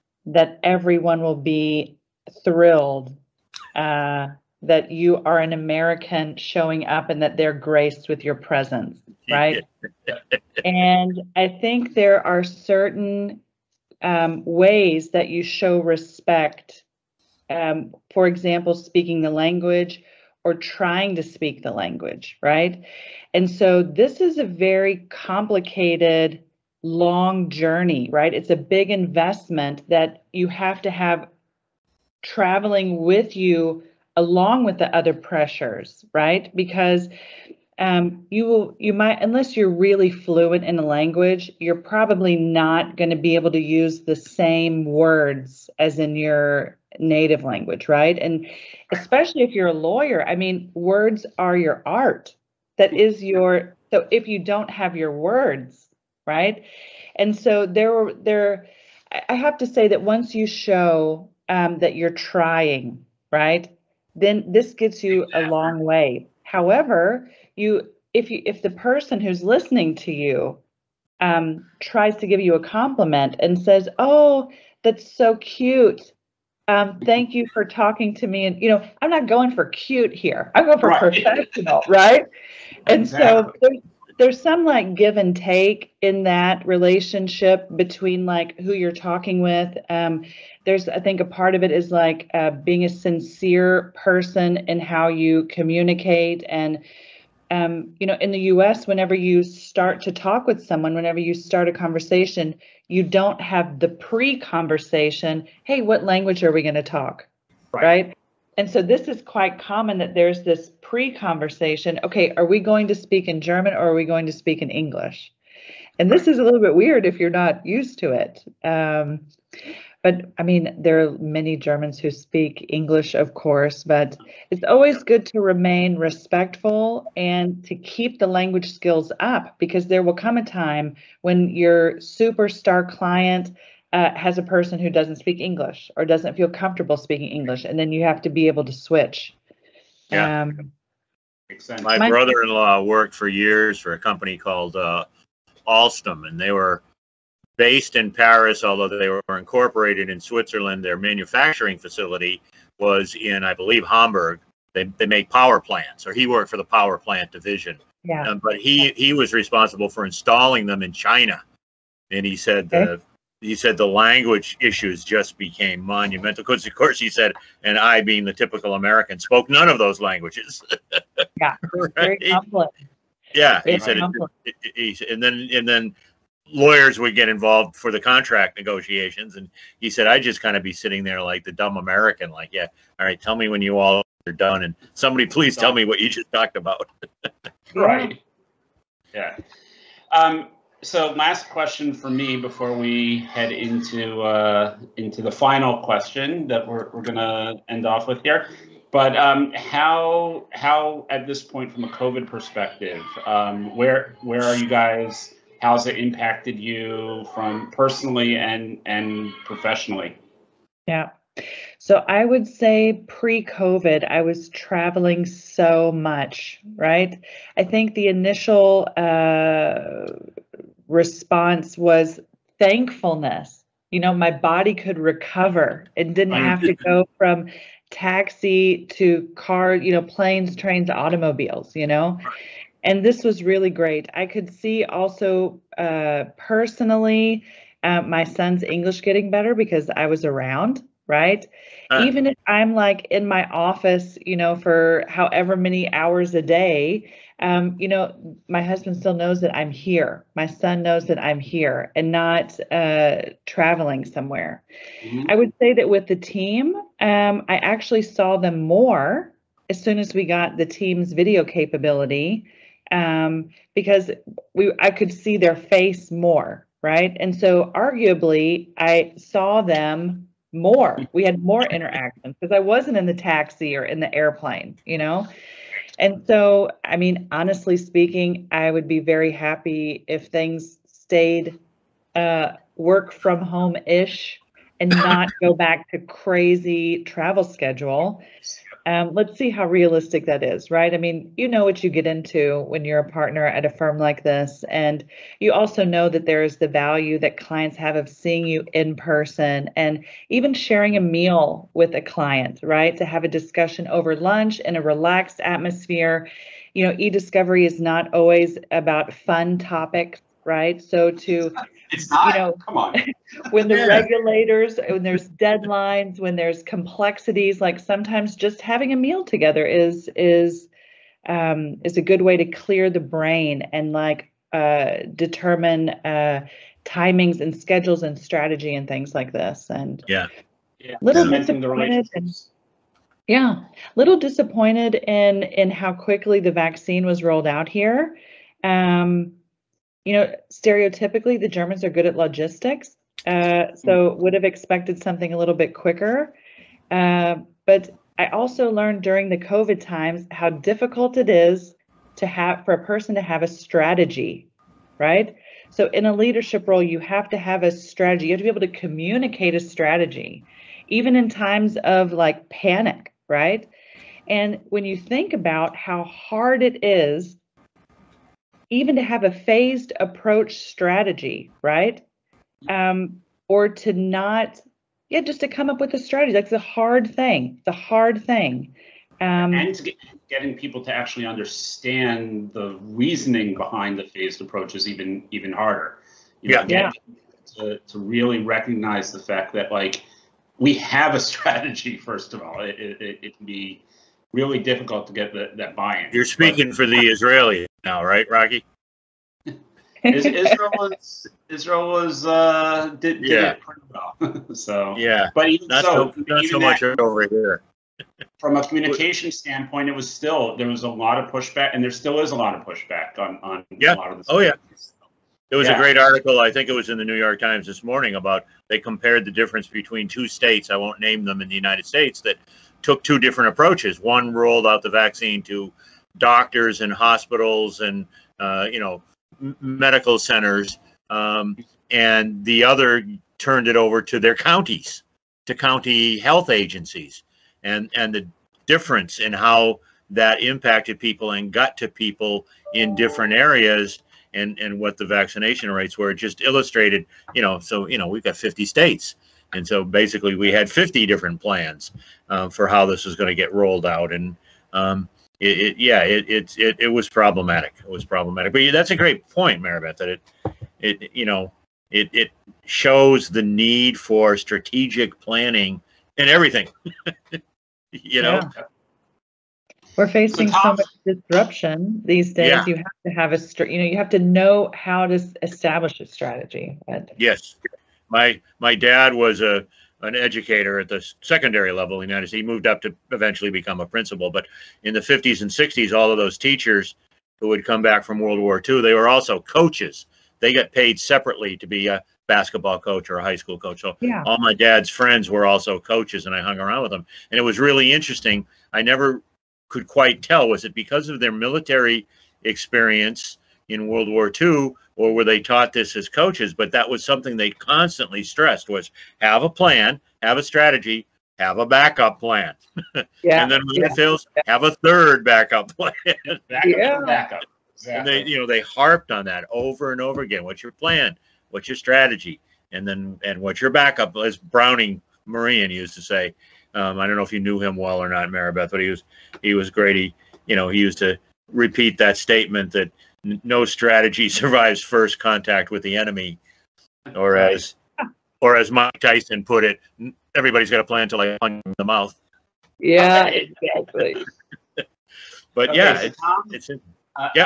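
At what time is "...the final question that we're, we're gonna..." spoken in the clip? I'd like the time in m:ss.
3:15.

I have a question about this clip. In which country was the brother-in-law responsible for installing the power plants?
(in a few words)
China.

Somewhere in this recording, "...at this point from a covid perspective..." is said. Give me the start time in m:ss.
3:21.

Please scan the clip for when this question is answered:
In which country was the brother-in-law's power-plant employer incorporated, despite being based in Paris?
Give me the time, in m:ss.
2:30.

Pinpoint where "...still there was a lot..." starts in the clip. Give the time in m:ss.
6:50.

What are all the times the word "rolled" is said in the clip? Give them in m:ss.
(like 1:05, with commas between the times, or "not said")
5:37, 7:04, 7:33.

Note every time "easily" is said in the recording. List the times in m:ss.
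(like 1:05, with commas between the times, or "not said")
not said.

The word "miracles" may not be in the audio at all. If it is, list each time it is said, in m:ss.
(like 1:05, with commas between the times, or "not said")
not said.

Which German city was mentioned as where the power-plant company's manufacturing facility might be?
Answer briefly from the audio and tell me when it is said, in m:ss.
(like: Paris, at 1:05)
Hamburg, at 2:33.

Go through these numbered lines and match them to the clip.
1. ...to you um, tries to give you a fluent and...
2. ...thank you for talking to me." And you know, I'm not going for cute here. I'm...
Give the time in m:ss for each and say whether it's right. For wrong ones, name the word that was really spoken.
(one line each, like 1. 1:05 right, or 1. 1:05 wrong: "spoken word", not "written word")
1. 1:09 wrong: "compliment", not "fluent"
2. 1:17 right.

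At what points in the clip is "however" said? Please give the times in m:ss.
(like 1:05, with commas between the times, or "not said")
1:06, 4:05.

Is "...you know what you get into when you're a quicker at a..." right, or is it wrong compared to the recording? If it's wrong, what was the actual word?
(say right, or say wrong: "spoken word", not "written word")
wrong: "partner", not "quicker".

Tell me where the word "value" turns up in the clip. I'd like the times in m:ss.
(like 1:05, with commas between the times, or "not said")
4:56.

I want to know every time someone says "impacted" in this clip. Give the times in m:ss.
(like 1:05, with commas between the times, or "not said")
3:25, 7:20.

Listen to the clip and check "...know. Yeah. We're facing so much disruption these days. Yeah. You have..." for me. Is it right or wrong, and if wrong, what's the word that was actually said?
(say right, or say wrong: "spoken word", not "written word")
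right.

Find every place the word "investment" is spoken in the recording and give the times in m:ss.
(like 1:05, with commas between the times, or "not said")
0:28.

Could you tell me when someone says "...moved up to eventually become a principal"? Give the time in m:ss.
8:02.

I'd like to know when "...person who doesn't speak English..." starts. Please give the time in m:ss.
2:14.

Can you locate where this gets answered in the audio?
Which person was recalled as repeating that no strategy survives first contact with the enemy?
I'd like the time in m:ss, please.
8:44.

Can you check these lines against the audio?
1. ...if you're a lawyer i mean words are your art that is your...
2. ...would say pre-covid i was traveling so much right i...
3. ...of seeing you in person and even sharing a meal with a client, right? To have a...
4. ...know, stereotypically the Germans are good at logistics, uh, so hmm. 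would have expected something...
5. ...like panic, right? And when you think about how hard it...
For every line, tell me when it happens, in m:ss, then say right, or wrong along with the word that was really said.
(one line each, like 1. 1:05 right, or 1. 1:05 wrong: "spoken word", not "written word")
1. 0:49 right
2. 3:32 right
3. 4:57 right
4. 5:40 right
5. 6:02 right.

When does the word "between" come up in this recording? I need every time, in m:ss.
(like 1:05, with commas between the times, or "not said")
1:27, 6:59.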